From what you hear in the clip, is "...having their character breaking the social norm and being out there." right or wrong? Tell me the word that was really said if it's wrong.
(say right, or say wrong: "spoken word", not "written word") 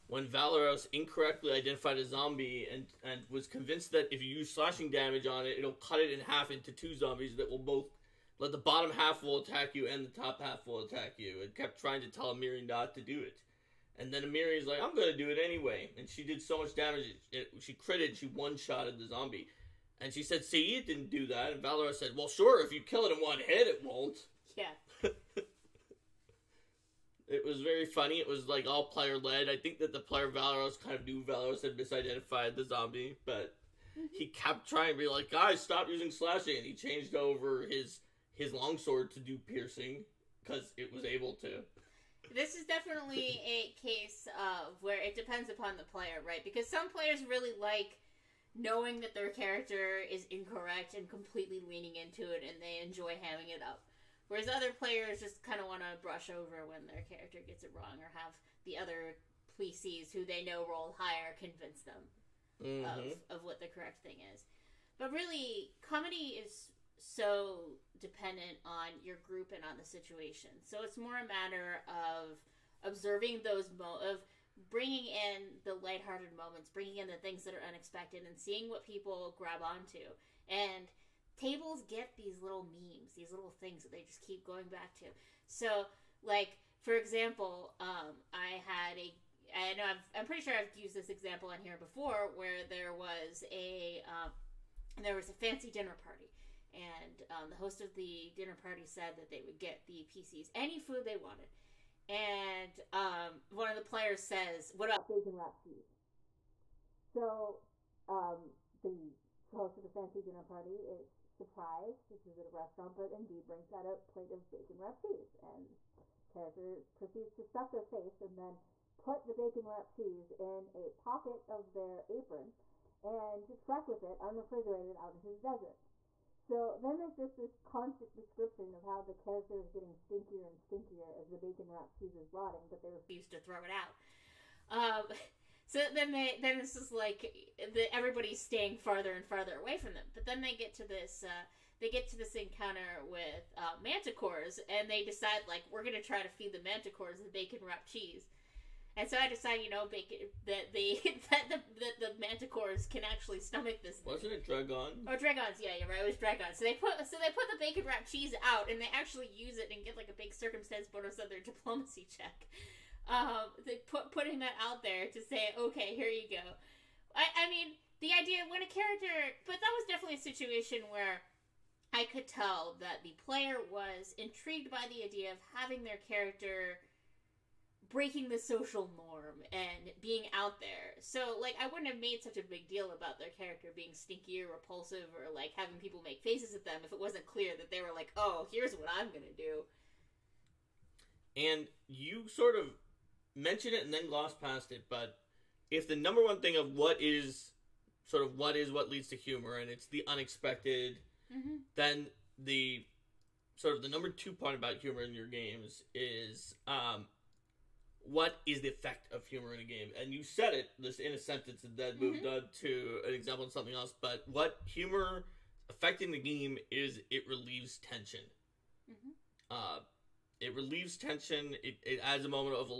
right.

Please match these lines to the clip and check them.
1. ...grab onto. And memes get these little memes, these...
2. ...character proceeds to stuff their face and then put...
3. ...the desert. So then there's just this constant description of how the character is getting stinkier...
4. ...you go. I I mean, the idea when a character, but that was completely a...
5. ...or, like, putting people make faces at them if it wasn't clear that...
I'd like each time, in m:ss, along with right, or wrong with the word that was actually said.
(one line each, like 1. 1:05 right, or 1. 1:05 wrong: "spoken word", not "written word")
1. 1:19 wrong: "tables", not "memes"
2. 1:56 right
3. 2:05 right
4. 2:46 wrong: "definitely", not "completely"
5. 3:05 wrong: "having", not "putting".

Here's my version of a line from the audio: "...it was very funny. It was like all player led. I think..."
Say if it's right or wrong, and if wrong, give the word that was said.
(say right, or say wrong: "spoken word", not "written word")
right.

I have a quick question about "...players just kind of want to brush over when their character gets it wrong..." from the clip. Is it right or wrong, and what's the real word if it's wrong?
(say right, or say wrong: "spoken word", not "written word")
right.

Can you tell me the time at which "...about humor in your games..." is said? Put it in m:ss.
3:24.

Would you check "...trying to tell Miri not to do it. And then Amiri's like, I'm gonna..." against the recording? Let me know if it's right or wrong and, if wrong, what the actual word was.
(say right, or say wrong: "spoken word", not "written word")
right.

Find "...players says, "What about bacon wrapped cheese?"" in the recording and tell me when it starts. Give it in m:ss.
1:43.